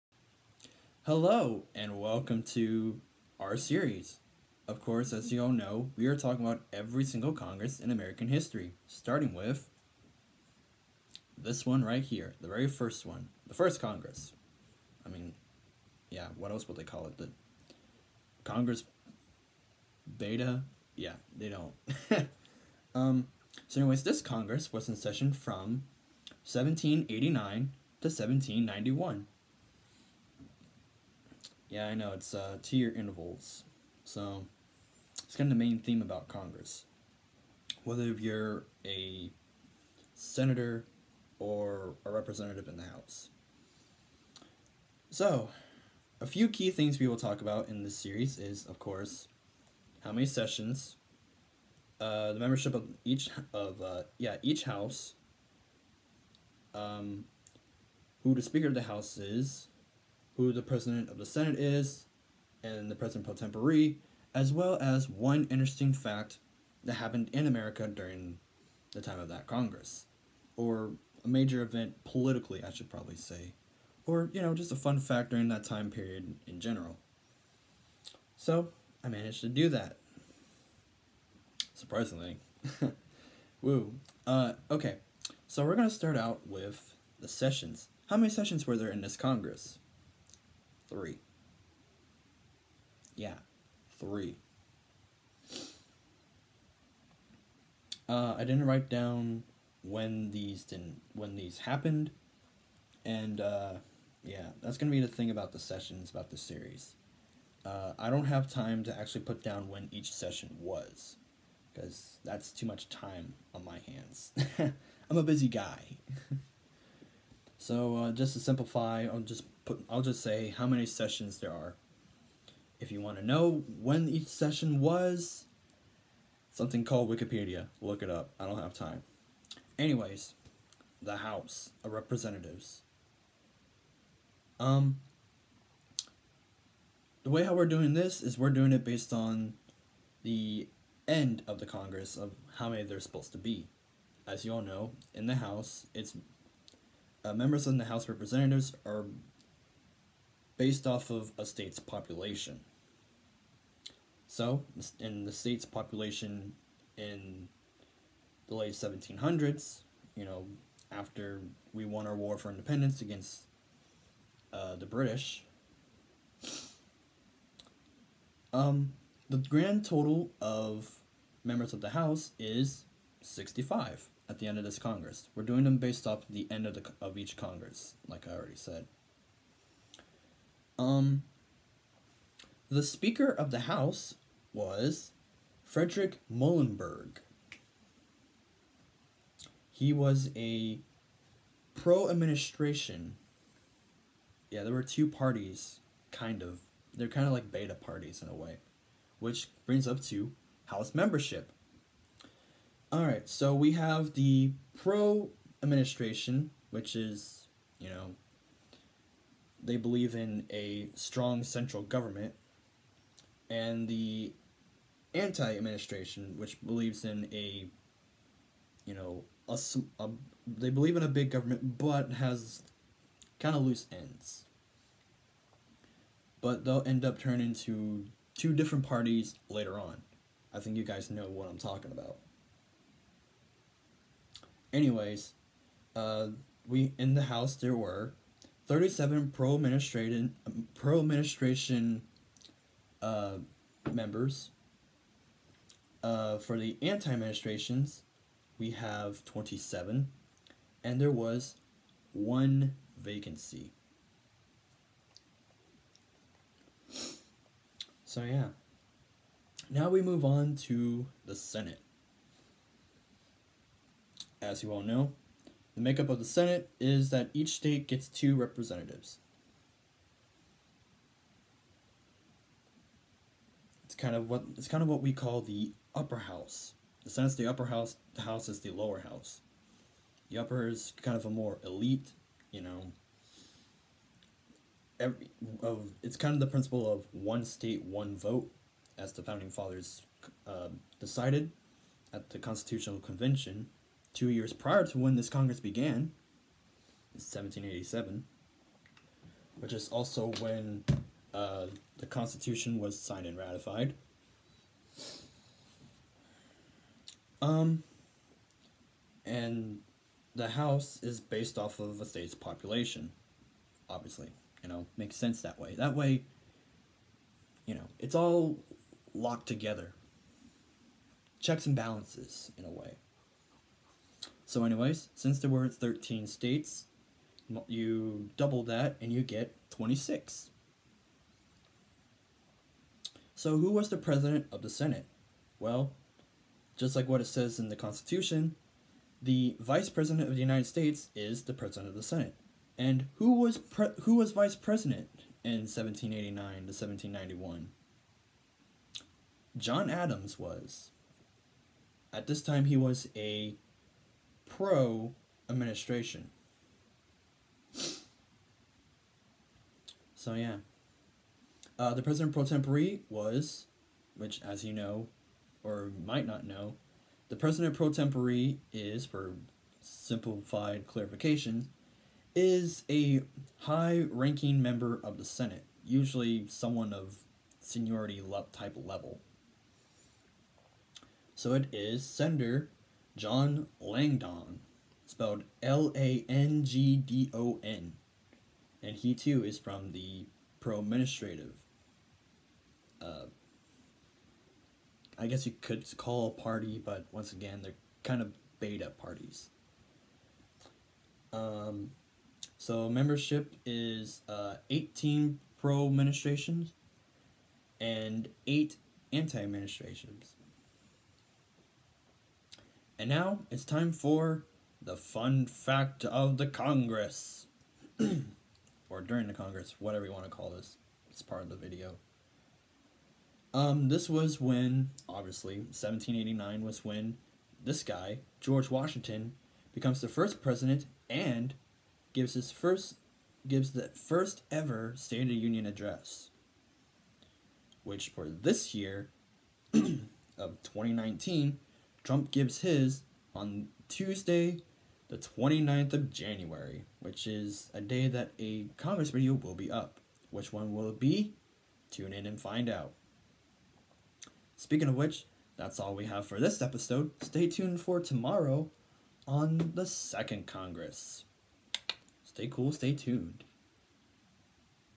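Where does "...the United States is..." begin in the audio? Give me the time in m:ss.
5:40.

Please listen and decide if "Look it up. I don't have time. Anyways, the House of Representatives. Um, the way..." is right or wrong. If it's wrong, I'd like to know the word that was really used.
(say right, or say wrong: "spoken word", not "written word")
right.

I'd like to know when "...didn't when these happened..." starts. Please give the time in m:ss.
1:40.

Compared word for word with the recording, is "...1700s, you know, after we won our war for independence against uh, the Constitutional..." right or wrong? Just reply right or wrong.
wrong.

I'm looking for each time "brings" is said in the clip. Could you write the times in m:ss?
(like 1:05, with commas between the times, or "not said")
3:19.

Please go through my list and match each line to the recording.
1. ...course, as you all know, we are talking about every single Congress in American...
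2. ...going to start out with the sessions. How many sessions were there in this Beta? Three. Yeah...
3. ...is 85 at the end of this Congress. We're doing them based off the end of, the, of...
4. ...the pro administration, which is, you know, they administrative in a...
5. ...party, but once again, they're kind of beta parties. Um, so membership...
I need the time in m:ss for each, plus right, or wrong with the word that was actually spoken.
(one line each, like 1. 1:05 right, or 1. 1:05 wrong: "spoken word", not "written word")
1. 0:04 right
2. 1:25 wrong: "Congress", not "Beta"
3. 2:52 wrong: "65", not "85"
4. 3:24 wrong: "believe", not "administrative"
5. 6:36 right.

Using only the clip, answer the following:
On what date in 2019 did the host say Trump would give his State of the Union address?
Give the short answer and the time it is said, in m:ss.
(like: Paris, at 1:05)
Tuesday, January 29, at 7:23.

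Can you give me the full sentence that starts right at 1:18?
So, I managed to do that.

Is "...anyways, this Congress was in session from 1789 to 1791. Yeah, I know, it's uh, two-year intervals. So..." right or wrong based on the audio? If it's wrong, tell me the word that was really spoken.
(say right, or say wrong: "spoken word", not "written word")
right.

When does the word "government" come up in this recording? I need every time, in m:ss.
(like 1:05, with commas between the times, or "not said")
3:31, 3:41.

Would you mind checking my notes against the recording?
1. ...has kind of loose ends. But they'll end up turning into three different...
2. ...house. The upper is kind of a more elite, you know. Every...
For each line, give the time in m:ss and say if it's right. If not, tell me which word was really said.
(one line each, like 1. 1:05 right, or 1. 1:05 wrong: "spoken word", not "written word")
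1. 3:42 wrong: "two", not "three"
2. 4:38 right.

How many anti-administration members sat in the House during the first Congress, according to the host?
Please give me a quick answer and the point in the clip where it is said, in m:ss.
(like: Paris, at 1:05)
27, at 4:09.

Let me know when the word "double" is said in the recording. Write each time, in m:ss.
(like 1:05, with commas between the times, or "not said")
5:28.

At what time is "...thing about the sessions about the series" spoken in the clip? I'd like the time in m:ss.
1:45.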